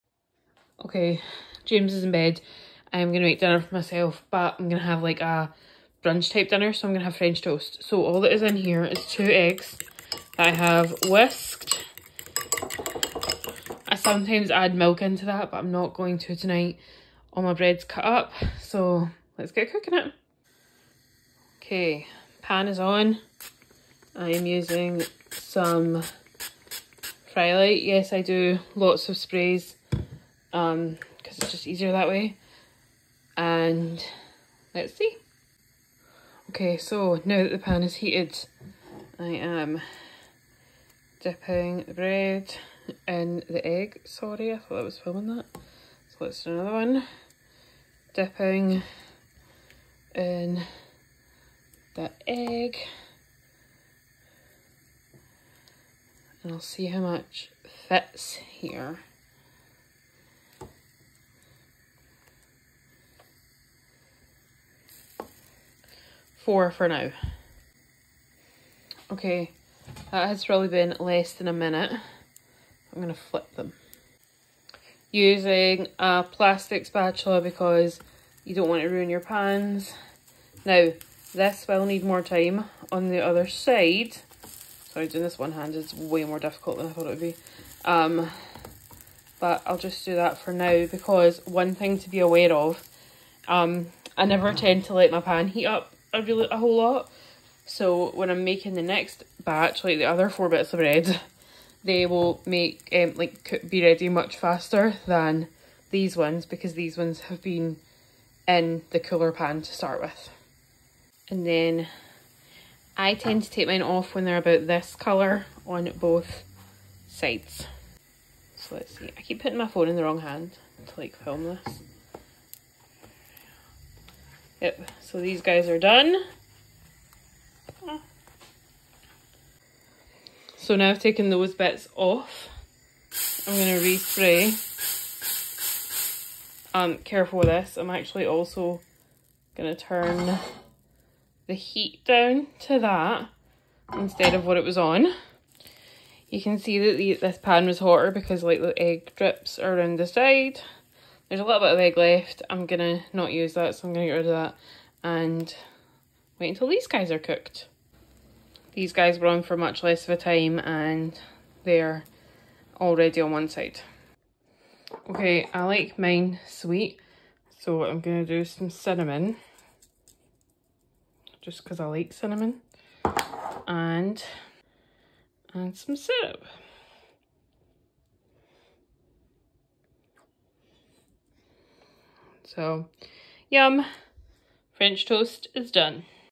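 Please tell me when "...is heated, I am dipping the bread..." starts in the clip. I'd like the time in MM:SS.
00:37.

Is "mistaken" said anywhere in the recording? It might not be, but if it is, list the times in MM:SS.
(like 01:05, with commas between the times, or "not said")
not said.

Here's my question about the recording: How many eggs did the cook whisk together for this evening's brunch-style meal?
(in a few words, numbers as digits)
2.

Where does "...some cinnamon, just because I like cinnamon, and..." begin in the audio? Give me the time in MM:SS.
02:48.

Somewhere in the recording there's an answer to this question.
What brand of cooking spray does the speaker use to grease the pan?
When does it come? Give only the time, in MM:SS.
00:27.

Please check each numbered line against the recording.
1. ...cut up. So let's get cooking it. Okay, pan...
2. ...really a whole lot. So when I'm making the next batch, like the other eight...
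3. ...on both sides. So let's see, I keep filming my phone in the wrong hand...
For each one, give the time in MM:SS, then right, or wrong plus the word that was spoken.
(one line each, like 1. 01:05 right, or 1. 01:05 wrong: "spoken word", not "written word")
1. 00:17 right
2. 01:36 wrong: "four", not "eight"
3. 01:55 wrong: "putting", not "filming".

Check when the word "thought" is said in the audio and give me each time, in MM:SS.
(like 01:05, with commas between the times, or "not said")
00:44, 01:26.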